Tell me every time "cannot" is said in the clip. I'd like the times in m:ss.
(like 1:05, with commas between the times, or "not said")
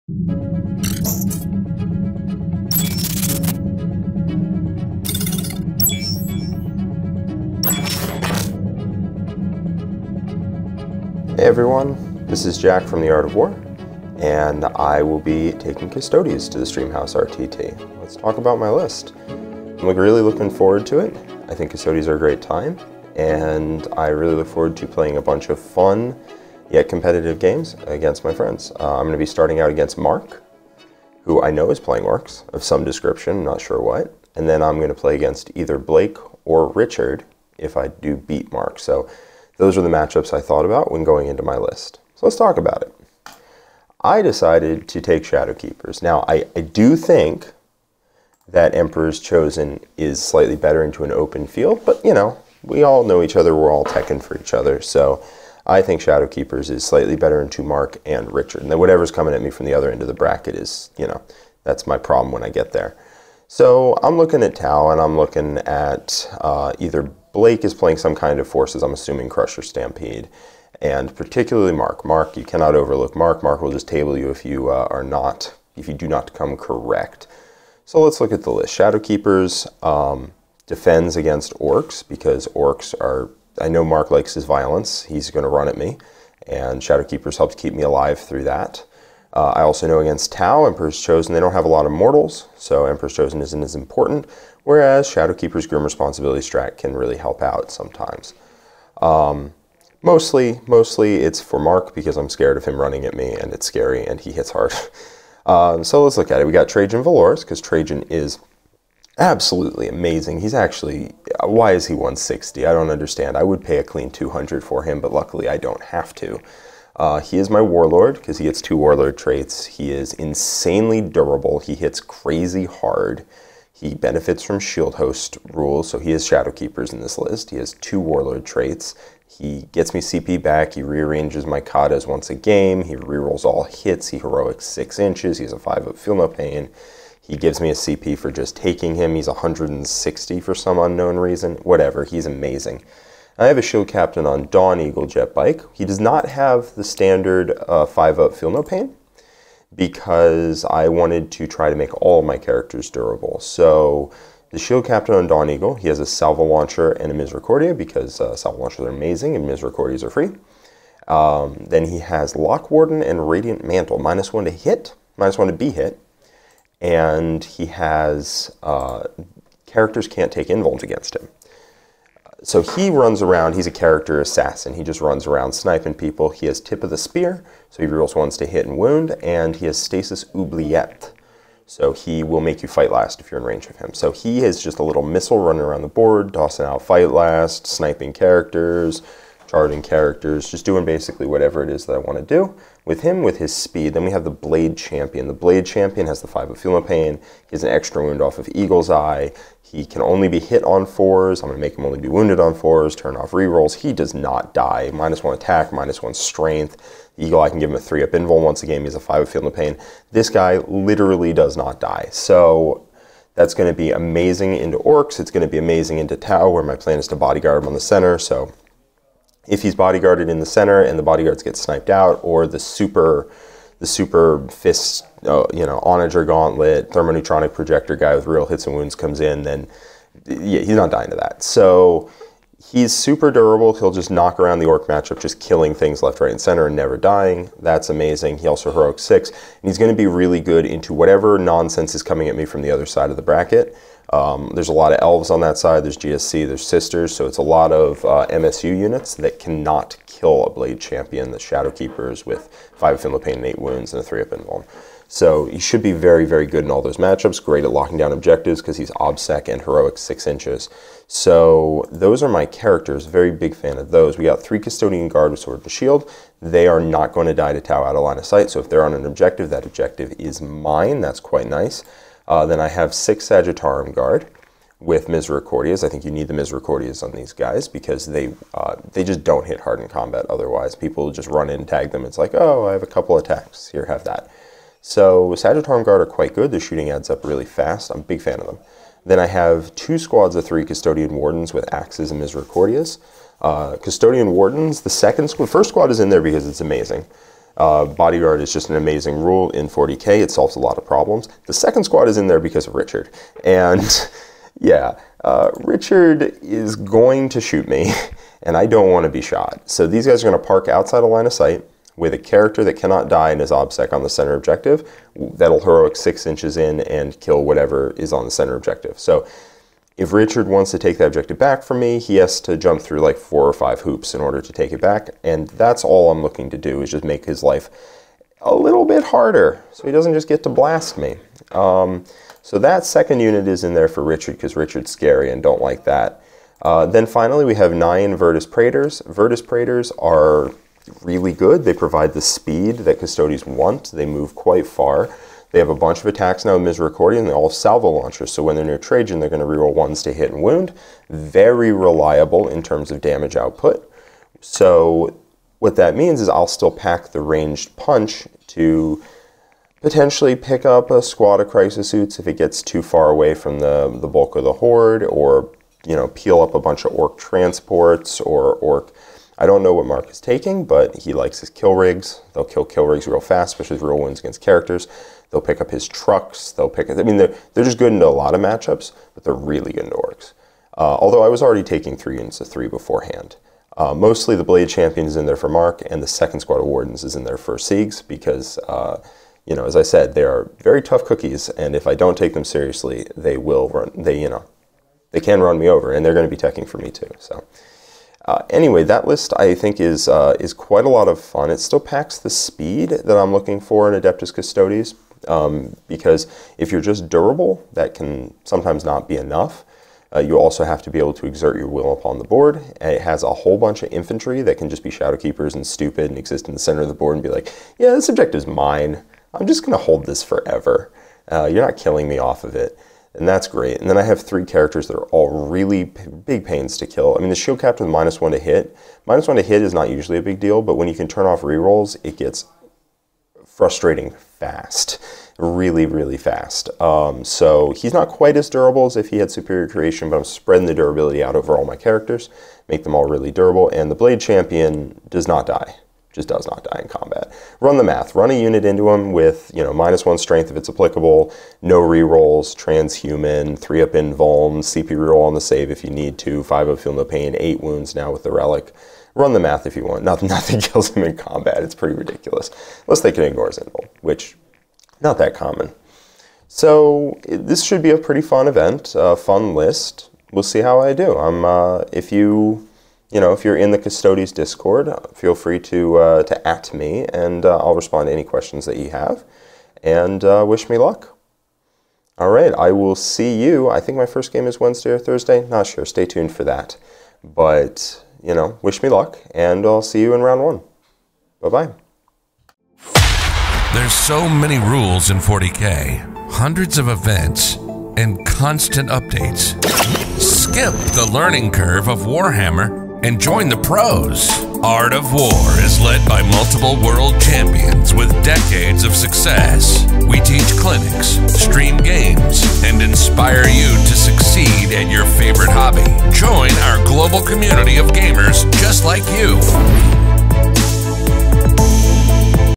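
1:12, 4:09, 5:12.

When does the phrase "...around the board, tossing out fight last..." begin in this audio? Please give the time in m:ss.
3:05.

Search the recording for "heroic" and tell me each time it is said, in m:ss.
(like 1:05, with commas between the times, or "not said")
2:14, 3:58, 4:19, 5:15.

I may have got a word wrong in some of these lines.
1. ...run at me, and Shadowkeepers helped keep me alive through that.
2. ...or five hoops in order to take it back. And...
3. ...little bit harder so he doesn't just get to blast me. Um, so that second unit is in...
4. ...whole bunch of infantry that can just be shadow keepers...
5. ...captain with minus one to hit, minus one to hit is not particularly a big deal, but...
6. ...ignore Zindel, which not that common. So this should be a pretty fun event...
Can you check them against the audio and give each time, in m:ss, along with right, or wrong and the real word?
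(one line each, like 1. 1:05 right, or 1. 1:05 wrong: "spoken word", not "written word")
1. 1:25 right
2. 5:23 right
3. 5:28 right
4. 6:53 right
5. 7:07 wrong: "usually", not "particularly"
6. 7:43 right.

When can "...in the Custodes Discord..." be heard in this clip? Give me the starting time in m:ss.
7:53.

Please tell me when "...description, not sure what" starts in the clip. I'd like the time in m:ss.
0:32.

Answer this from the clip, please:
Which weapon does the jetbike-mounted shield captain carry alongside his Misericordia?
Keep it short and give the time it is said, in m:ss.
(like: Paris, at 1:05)
salvo launcher, at 2:36.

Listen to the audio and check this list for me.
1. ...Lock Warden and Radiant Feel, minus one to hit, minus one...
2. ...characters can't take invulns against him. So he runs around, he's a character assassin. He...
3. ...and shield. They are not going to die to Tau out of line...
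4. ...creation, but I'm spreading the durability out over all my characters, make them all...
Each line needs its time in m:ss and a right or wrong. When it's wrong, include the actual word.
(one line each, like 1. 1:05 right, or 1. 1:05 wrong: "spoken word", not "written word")
1. 2:42 wrong: "Mantle", not "Feel"
2. 2:49 right
3. 4:25 right
4. 7:19 right.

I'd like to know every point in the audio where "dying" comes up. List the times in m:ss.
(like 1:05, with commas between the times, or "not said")
3:50, 3:56.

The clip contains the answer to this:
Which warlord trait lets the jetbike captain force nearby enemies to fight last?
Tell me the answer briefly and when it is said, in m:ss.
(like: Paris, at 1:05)
Stasis Oubliette, at 2:59.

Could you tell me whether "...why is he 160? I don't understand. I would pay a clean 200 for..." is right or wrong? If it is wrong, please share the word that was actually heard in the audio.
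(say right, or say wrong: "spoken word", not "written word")
right.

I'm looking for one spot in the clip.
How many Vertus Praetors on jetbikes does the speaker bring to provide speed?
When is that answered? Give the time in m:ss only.
5:37.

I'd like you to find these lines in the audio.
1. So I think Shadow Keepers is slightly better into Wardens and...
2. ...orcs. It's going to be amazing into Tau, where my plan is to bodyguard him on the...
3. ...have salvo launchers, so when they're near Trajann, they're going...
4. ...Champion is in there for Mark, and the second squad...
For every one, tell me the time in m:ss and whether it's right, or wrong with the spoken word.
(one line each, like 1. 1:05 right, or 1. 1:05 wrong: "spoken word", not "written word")
1. 0:54 wrong: "Mark", not "Wardens"
2. 3:34 right
3. 5:47 right
4. 6:24 right.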